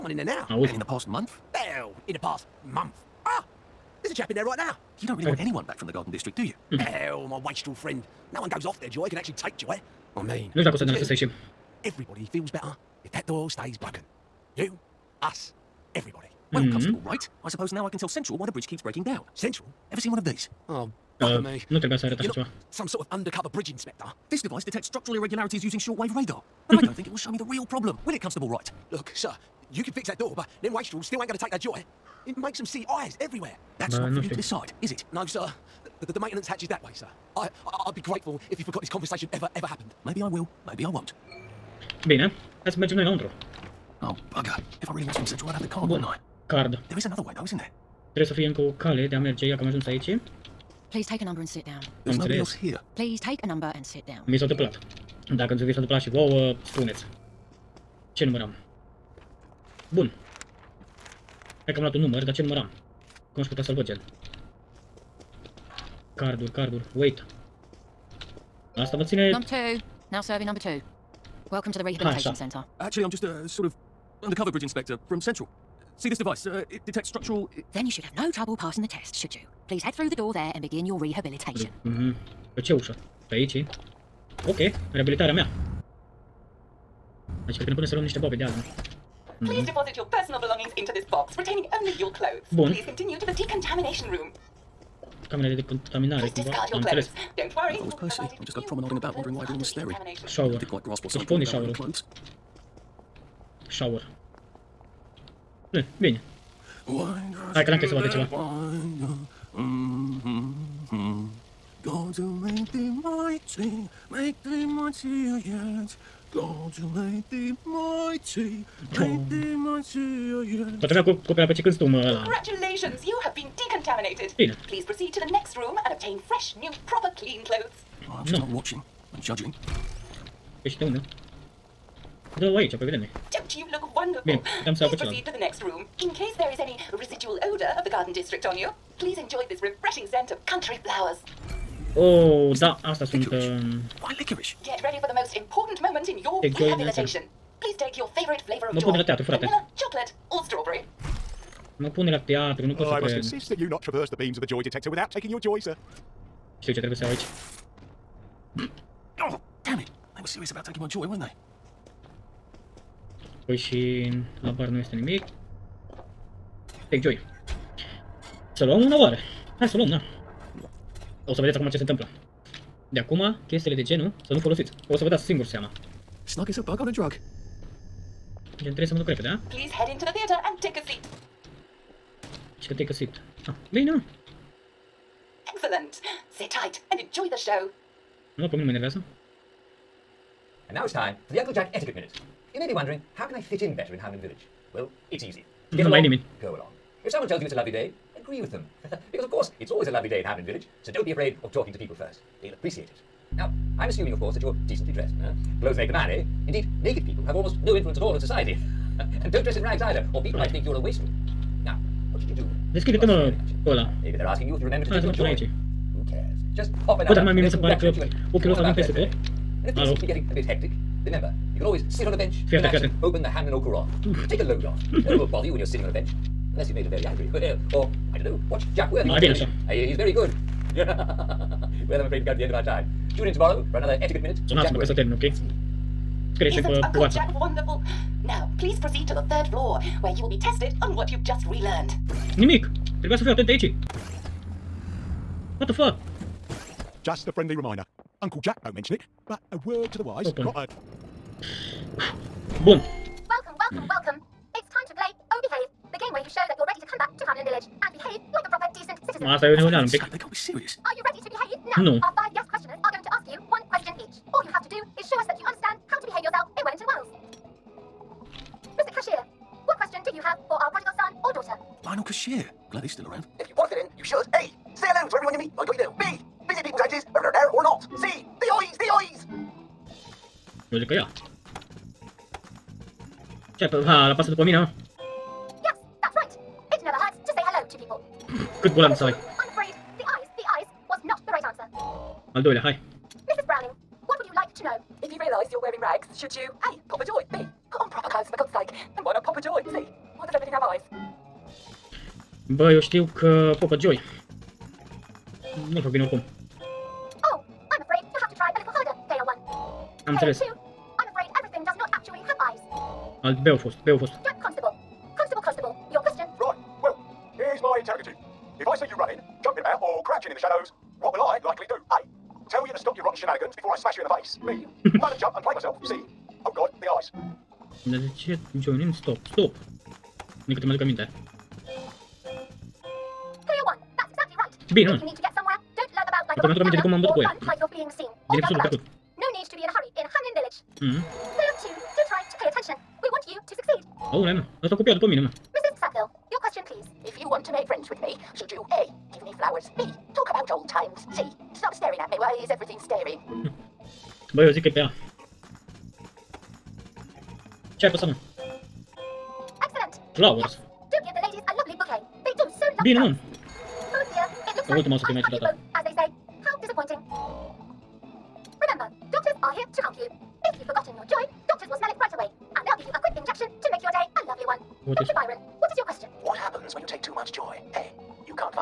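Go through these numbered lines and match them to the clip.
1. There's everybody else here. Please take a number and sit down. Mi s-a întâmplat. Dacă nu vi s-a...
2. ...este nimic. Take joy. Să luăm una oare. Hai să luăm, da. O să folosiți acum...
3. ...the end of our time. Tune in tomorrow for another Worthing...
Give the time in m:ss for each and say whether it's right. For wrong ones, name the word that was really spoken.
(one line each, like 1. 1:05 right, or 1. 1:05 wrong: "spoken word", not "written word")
1. 0:52 wrong: "nobody", not "everybody"
2. 2:44 wrong: "vedeți", not "folosiți"
3. 3:52 wrong: "Etiquette", not "Worthing".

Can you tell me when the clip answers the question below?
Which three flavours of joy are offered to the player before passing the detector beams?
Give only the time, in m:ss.
2:29.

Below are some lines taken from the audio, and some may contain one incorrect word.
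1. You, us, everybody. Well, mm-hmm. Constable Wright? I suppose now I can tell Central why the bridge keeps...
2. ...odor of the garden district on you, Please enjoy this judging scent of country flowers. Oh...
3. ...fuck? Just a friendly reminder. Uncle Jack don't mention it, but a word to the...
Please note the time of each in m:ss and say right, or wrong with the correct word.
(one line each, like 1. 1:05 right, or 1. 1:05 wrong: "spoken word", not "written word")
1. 0:14 right
2. 2:17 wrong: "refreshing", not "judging"
3. 4:05 right.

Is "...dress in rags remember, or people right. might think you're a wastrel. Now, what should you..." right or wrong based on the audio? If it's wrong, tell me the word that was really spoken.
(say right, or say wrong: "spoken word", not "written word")
wrong: "either", not "remember".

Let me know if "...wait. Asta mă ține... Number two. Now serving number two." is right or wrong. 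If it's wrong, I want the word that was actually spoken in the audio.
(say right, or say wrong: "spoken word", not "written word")
right.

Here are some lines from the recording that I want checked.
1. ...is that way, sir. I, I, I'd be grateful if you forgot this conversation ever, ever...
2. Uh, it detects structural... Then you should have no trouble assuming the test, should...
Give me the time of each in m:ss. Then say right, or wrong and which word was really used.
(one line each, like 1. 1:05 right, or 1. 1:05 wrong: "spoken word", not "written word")
1. 0:36 right
2. 1:16 wrong: "passing", not "assuming".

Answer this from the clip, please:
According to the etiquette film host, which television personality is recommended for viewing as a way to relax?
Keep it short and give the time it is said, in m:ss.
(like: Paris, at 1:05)
Jack Worthing, at 3:48.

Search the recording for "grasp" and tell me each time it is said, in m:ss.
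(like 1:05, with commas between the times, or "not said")
1:40.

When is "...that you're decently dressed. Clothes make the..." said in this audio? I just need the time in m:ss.
3:24.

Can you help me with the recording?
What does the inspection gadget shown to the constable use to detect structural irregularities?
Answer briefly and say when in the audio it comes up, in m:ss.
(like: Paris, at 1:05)
Shortwave radar, at 0:25.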